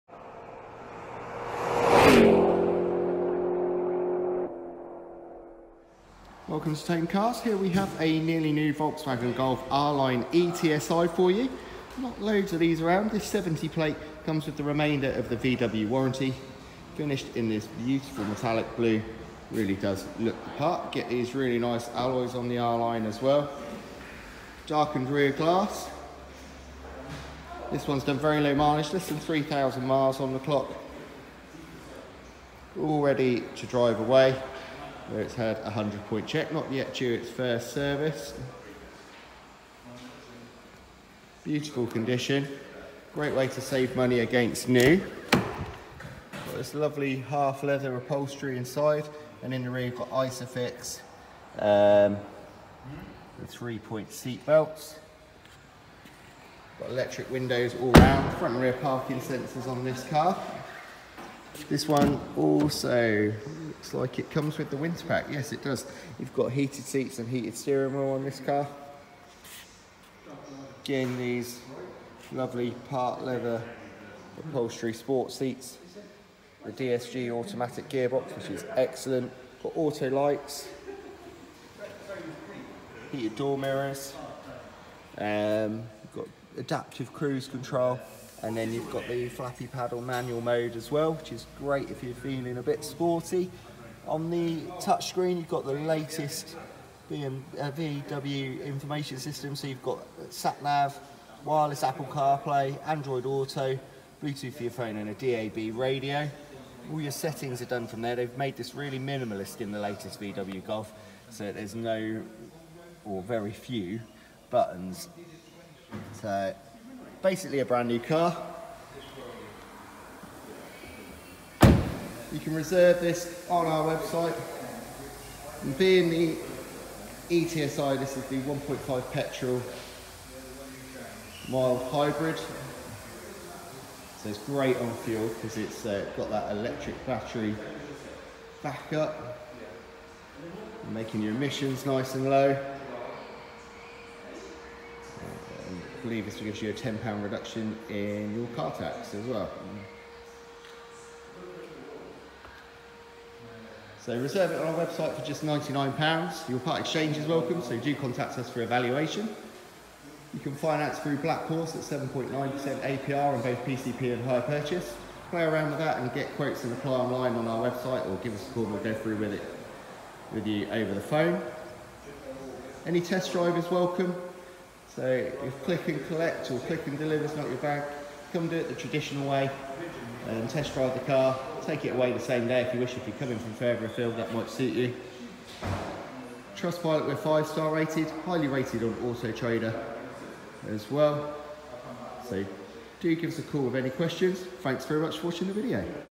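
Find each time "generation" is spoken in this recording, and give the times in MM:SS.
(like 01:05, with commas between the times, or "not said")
not said.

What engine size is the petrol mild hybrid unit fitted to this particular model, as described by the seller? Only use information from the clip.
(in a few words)
1.5.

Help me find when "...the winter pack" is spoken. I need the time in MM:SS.
01:04.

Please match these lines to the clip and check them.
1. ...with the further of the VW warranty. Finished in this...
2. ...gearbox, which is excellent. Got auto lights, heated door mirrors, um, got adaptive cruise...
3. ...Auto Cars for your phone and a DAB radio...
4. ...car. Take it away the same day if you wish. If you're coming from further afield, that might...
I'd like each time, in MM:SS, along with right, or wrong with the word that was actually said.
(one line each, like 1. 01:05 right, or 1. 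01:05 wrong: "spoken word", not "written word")
1. 00:14 wrong: "remainder", not "further"
2. 01:17 right
3. 01:43 wrong: "Bluetooth", not "Cars"
4. 03:01 right.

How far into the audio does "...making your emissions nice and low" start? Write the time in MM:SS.
02:20.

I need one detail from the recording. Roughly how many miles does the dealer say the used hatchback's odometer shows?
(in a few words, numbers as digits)
less than 3,000 miles.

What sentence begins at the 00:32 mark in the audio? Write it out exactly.
All ready to drive away where it's had a 100 point check, not yet due its first service.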